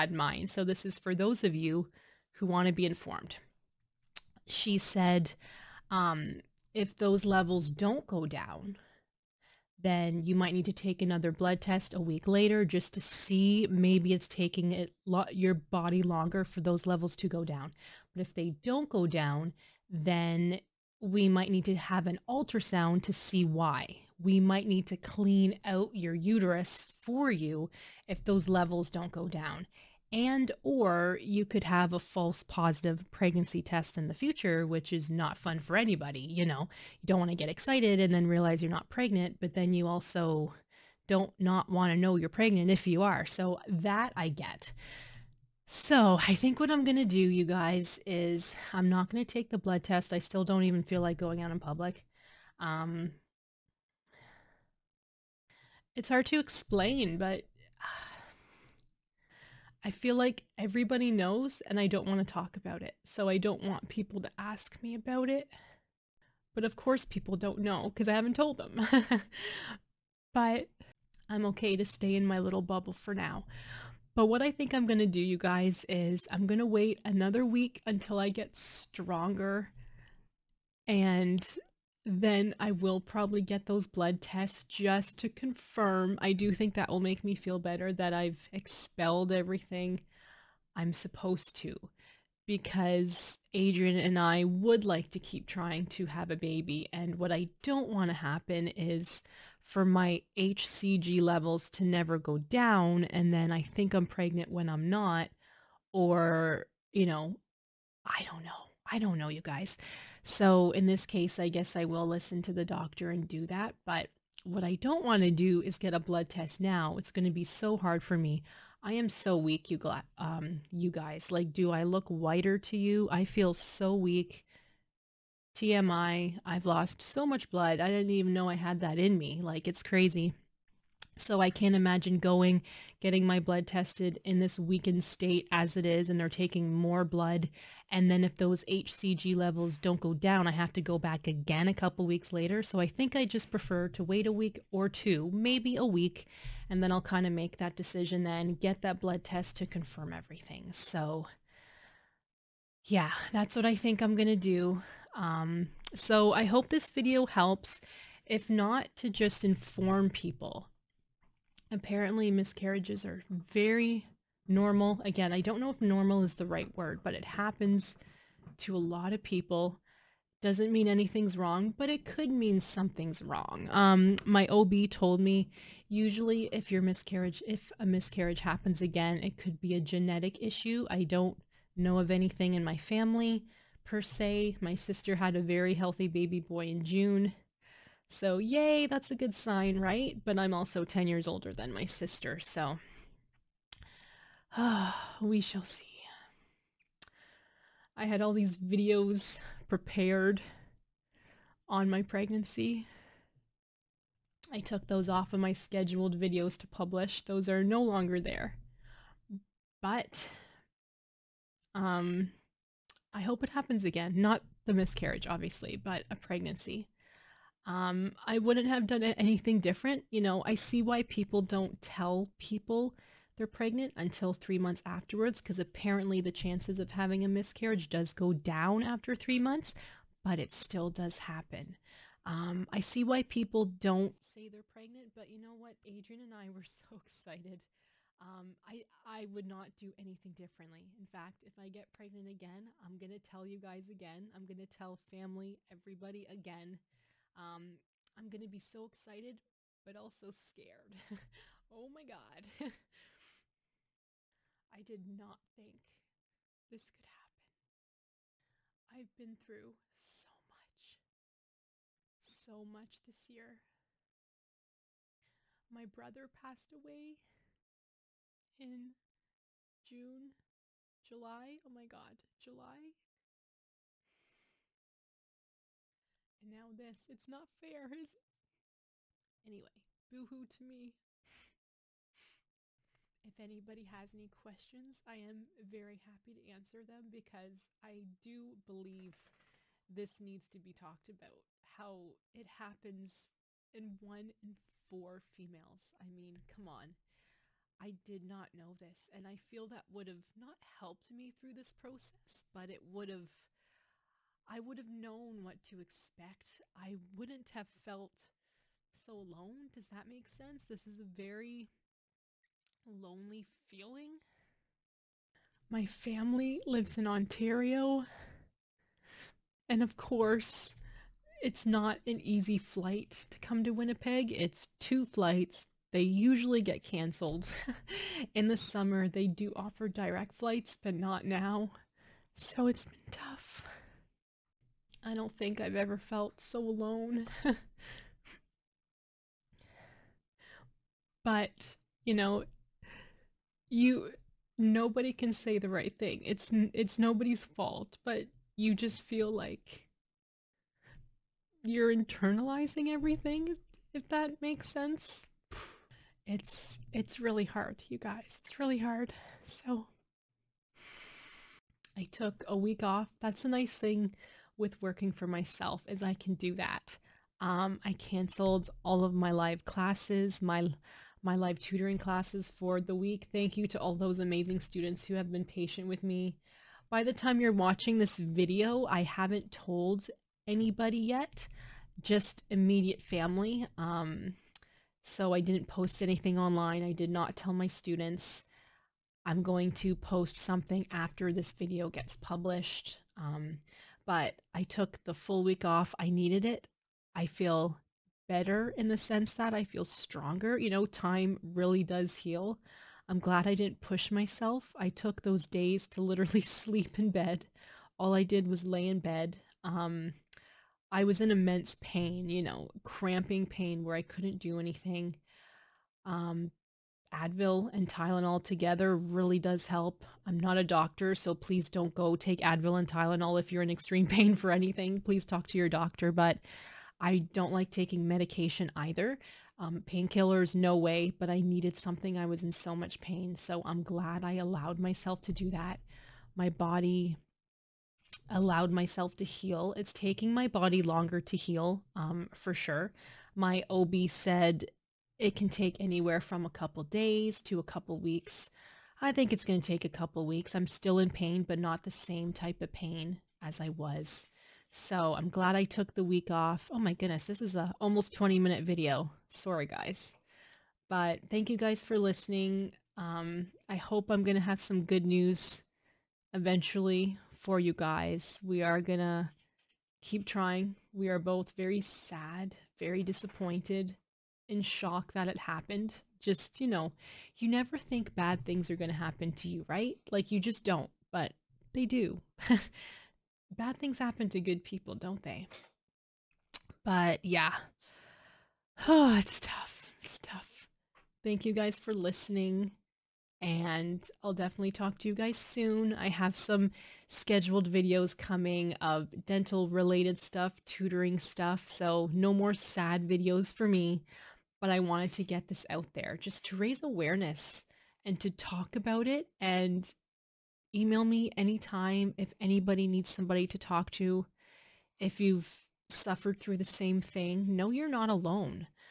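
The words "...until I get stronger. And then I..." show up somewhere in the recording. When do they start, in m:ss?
1:17.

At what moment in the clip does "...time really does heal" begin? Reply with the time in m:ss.
6:40.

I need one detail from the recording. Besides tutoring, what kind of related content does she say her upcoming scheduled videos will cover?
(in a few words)
dental.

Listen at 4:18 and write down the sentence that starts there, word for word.
I've been through so much, so much this year.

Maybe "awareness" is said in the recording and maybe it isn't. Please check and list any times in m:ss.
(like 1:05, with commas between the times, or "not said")
8:26.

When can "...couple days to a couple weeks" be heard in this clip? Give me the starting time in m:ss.
7:26.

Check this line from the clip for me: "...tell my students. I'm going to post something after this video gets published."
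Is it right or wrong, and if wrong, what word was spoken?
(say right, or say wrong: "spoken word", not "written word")
right.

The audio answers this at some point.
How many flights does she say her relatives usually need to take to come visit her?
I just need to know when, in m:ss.
5:24.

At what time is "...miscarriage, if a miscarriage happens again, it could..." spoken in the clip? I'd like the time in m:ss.
2:56.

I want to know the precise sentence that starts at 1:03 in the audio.
So I don't want people to ask me about it.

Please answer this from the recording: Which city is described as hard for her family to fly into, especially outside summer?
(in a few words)
Winnipeg.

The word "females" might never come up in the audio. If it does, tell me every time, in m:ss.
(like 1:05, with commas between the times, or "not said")
4:55.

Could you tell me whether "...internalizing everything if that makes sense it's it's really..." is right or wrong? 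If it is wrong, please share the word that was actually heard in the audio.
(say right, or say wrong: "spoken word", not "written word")
right.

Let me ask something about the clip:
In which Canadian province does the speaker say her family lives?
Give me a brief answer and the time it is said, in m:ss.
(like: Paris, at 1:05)
Ontario, at 5:17.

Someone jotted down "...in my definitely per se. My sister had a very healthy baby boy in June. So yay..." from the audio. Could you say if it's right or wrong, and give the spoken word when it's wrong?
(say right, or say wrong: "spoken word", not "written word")
wrong: "family", not "definitely".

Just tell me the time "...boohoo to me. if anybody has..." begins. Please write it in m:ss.
4:40.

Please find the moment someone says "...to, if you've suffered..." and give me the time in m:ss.
8:33.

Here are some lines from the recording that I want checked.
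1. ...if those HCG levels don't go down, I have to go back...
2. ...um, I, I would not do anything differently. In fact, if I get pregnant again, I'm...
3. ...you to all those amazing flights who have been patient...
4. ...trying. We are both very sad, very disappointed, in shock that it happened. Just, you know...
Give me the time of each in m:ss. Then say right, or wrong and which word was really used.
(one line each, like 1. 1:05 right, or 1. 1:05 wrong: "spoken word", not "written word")
1. 2:18 right
2. 3:58 right
3. 6:13 wrong: "students", not "flights"
4. 7:50 right.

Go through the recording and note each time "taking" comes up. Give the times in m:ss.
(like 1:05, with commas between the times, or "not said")
0:14, 2:16, 7:07, 7:19.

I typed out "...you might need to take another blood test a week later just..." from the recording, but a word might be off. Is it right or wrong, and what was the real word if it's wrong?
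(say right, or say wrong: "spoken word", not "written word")
right.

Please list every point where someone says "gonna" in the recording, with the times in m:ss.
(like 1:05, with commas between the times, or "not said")
7:48, 7:58.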